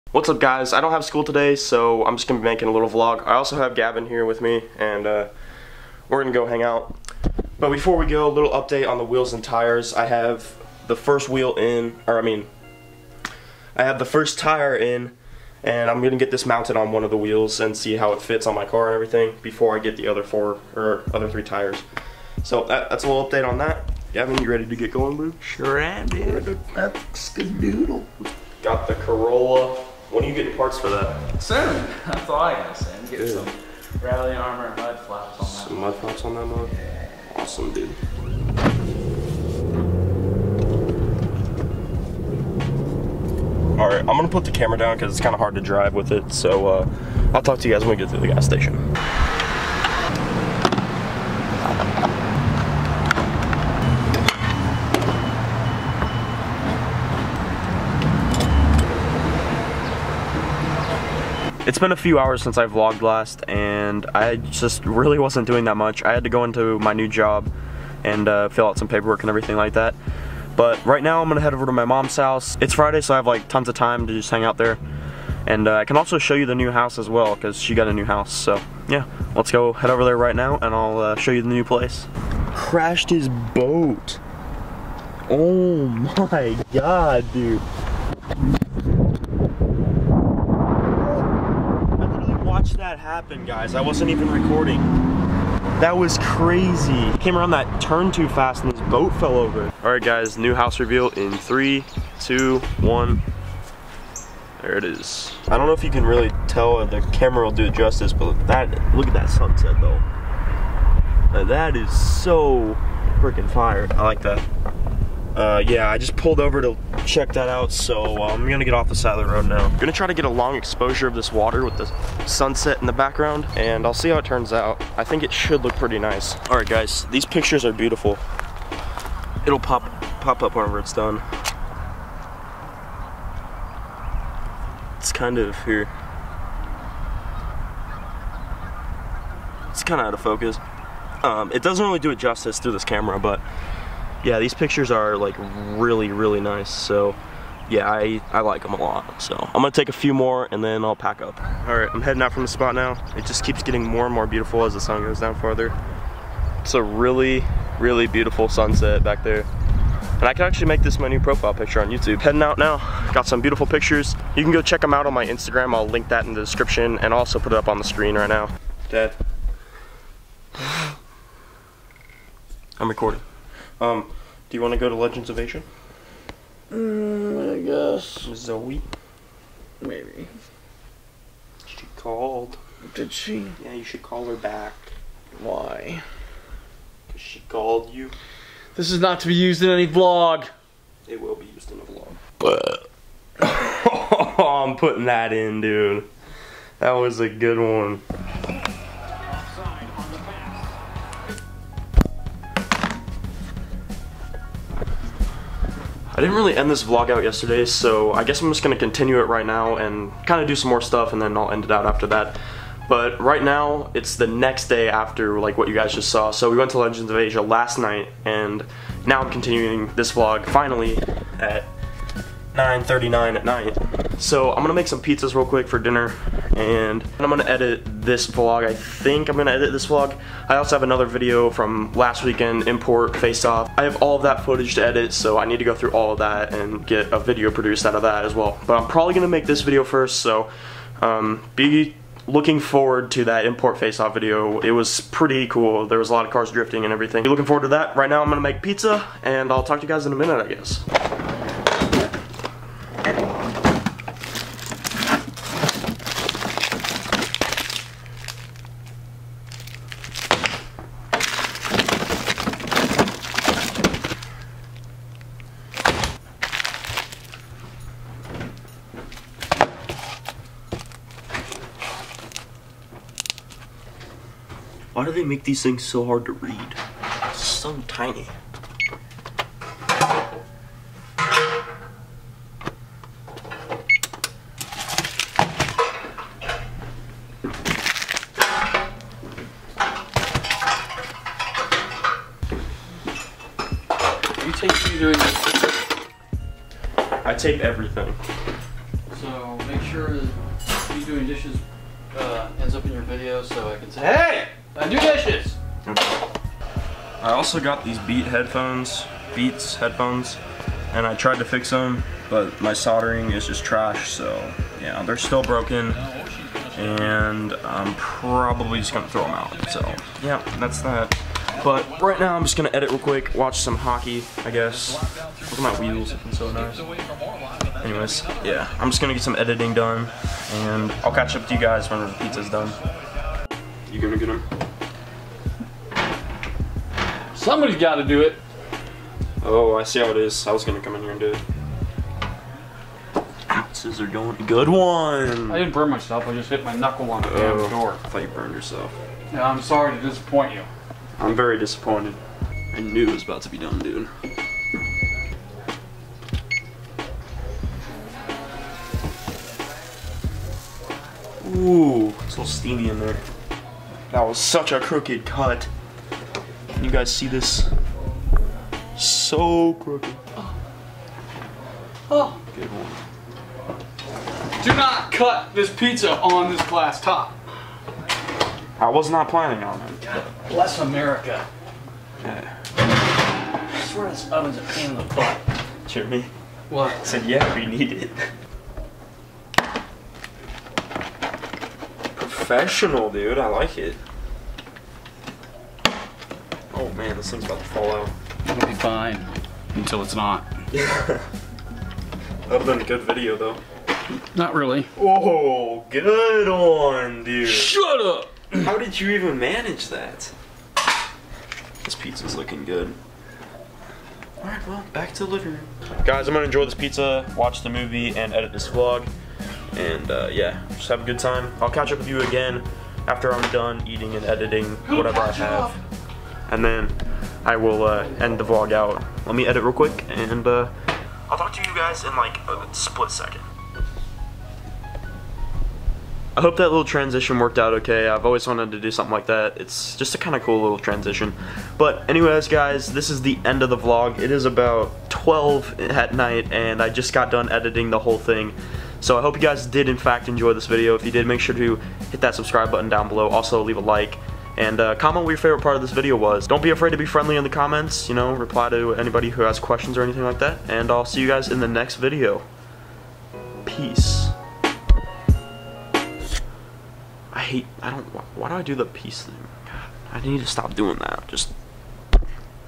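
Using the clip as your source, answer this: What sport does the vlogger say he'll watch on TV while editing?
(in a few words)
Hockey.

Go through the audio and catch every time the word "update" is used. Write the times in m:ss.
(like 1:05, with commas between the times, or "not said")
0:08, 0:23.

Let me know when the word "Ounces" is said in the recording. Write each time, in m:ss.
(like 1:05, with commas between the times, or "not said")
5:43.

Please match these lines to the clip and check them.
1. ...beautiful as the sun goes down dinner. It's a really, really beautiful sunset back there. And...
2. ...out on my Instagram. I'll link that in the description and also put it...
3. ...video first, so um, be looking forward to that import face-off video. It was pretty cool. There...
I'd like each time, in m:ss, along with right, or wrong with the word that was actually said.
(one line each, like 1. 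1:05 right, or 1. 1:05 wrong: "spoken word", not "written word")
1. 2:34 wrong: "farther", not "dinner"
2. 2:44 right
3. 3:59 right.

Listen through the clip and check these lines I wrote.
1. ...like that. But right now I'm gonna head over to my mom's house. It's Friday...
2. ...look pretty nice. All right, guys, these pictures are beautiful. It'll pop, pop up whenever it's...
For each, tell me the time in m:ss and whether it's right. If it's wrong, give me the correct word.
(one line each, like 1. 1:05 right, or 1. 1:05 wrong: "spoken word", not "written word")
1. 1:09 right
2. 2:05 right.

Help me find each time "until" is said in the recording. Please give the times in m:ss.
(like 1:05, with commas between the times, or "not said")
6:39.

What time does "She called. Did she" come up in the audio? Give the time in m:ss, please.
3:01.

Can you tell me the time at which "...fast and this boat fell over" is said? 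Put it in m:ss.
1:38.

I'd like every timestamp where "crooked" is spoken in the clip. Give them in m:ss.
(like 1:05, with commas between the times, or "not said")
6:04, 6:09.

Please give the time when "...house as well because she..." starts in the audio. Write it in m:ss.
1:16.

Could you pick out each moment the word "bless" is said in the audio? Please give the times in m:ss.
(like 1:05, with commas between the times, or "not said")
6:20.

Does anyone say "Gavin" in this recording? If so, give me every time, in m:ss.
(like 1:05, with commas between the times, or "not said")
0:03, 0:24.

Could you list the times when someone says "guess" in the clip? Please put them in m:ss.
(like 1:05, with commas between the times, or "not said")
2:57, 3:28, 4:10, 5:24.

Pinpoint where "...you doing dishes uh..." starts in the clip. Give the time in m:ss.
5:00.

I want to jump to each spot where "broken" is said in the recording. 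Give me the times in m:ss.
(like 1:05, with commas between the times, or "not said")
5:15.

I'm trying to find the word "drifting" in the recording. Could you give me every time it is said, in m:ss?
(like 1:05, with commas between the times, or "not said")
4:06.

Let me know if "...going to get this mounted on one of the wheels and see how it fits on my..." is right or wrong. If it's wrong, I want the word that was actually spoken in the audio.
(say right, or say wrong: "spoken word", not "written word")
right.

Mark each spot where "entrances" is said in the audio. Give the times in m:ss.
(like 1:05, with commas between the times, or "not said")
not said.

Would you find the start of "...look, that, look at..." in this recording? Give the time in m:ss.
1:48.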